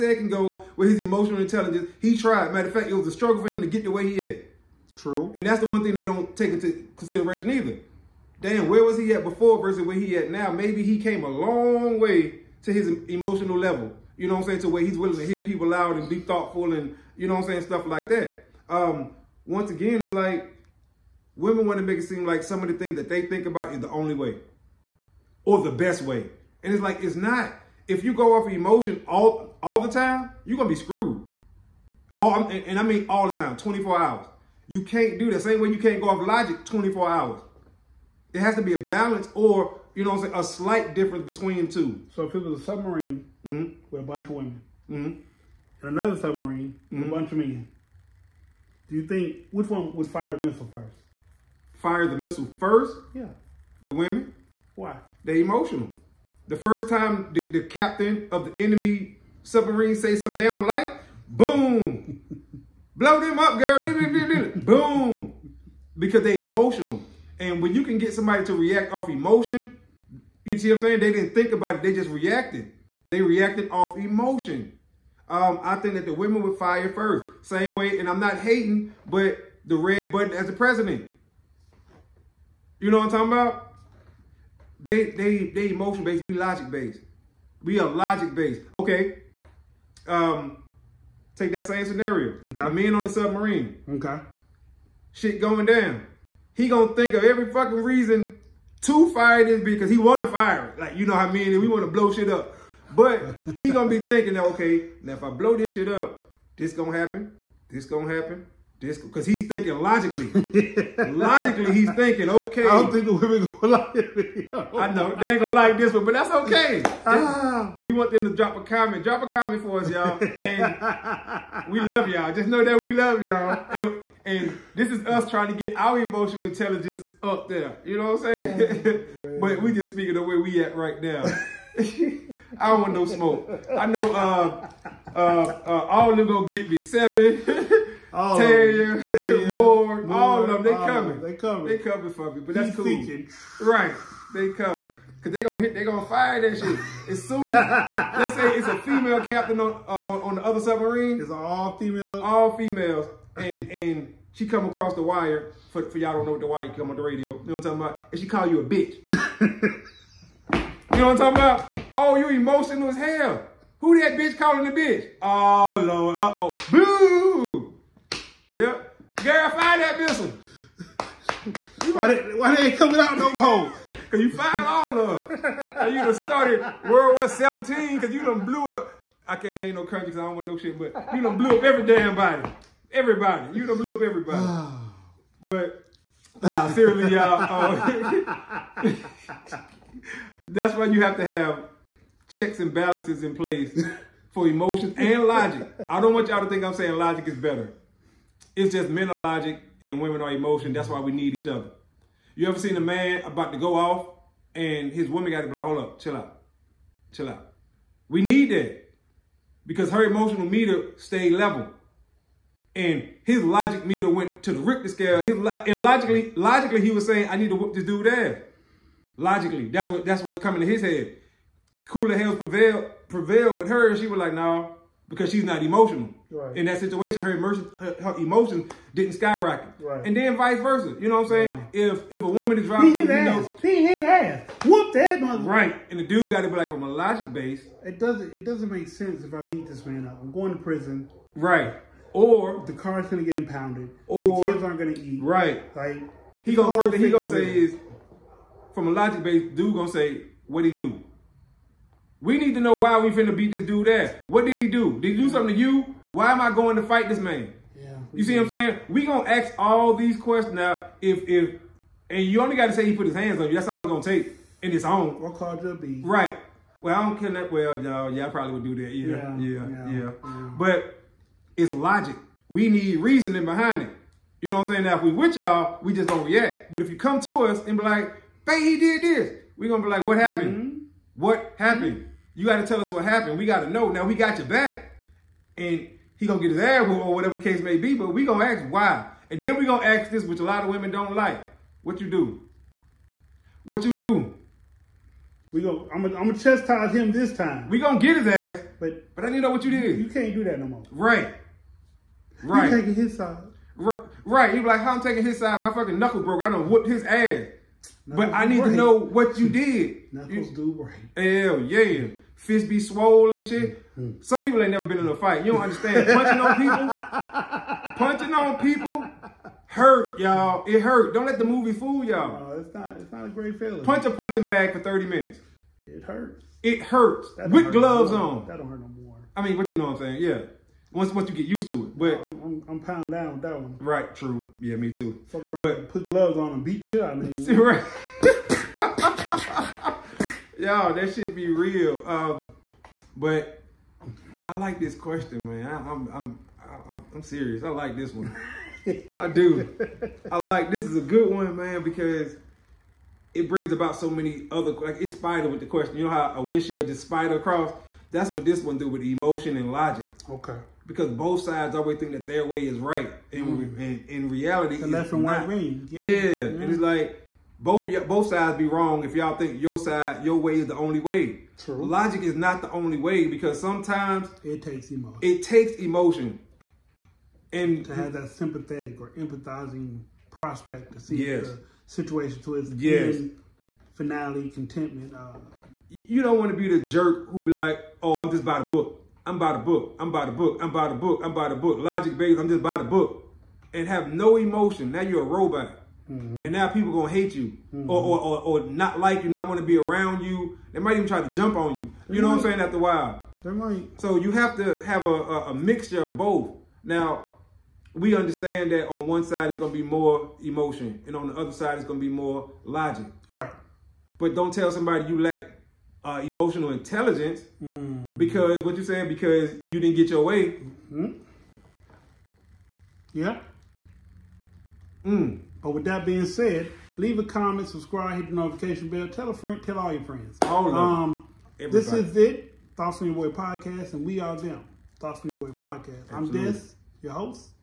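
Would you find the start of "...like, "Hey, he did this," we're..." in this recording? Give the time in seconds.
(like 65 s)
277 s.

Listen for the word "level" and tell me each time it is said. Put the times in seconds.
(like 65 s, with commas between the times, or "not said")
13 s, 211 s.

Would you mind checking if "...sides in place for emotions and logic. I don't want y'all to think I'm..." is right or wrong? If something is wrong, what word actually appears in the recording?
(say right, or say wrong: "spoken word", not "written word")
wrong: "balances", not "sides".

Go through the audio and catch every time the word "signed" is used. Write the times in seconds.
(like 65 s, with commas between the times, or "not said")
not said.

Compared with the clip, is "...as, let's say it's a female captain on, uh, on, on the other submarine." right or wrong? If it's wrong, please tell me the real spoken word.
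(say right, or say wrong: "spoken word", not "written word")
right.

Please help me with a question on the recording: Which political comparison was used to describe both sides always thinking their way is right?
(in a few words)
left and right wing.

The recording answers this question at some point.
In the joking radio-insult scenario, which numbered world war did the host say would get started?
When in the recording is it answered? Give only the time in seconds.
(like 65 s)
176 s.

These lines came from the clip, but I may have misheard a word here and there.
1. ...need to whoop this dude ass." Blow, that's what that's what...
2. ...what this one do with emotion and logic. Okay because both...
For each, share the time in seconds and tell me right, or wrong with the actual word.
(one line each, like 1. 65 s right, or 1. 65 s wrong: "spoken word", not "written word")
1. 217 s wrong: "Logically", not "Blow"
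2. 358 s right.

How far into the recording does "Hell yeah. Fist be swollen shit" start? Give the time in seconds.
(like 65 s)
311 s.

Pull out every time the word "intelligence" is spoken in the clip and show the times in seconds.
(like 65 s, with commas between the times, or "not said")
1 s, 126 s, 416 s.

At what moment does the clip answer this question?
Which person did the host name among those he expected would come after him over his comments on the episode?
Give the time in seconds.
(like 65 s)
139 s.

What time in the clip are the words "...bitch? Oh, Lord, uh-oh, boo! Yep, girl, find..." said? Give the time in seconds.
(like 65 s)
164 s.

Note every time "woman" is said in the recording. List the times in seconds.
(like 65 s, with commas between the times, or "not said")
205 s, 232 s.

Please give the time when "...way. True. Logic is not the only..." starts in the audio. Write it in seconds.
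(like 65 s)
371 s.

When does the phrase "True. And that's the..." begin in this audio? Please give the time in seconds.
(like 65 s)
4 s.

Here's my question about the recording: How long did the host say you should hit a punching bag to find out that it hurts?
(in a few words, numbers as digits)
30 minutes.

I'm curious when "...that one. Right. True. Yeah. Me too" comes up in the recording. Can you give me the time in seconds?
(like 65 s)
333 s.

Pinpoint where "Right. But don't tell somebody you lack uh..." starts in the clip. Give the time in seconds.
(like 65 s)
413 s.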